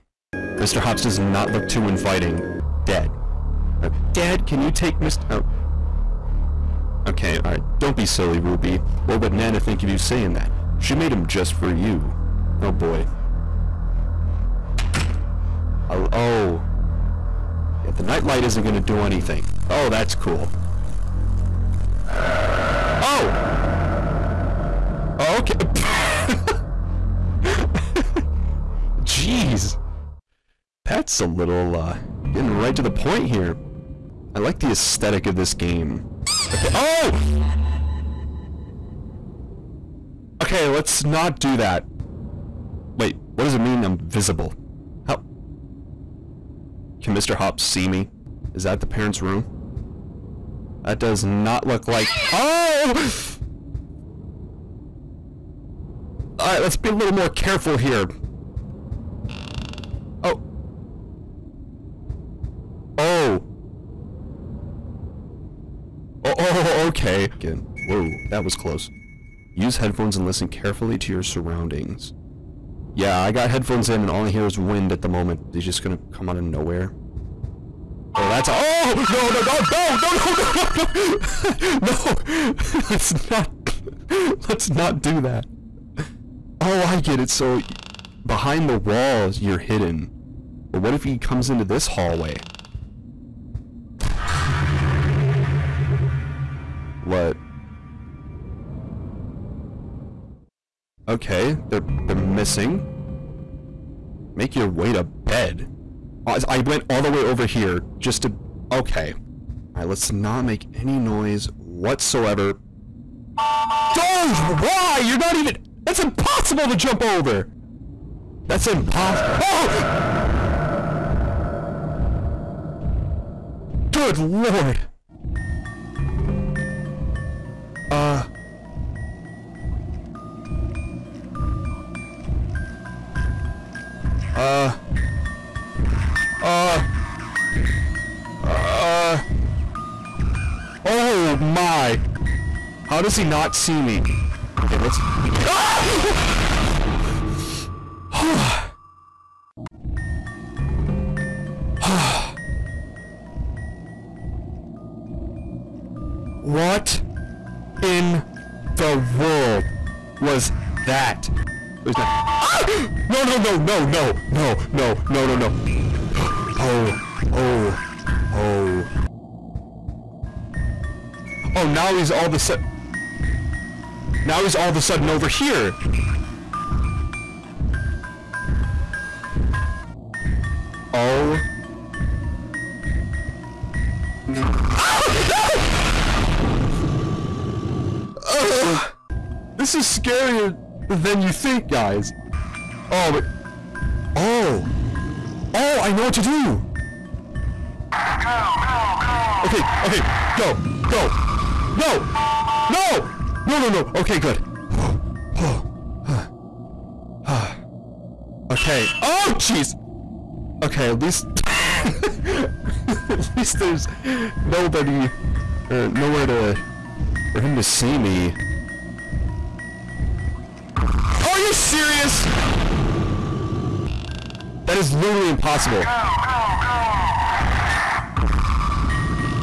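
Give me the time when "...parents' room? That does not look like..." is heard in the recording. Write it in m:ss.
0:48.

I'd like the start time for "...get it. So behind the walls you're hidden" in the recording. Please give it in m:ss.
1:26.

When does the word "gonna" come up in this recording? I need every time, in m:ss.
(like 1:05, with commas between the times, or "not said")
0:18, 1:15.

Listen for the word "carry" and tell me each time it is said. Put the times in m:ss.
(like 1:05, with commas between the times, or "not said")
not said.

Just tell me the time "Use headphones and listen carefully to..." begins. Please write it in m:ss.
1:09.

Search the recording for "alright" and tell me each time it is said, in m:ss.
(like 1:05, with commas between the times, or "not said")
0:07, 0:56.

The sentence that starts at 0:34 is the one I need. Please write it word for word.
I like the aesthetic of this game.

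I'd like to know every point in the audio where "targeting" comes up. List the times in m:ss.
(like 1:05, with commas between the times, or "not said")
not said.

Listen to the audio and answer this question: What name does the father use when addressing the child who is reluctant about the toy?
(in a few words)
Ruby.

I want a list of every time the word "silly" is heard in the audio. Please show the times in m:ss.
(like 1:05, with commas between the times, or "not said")
0:08.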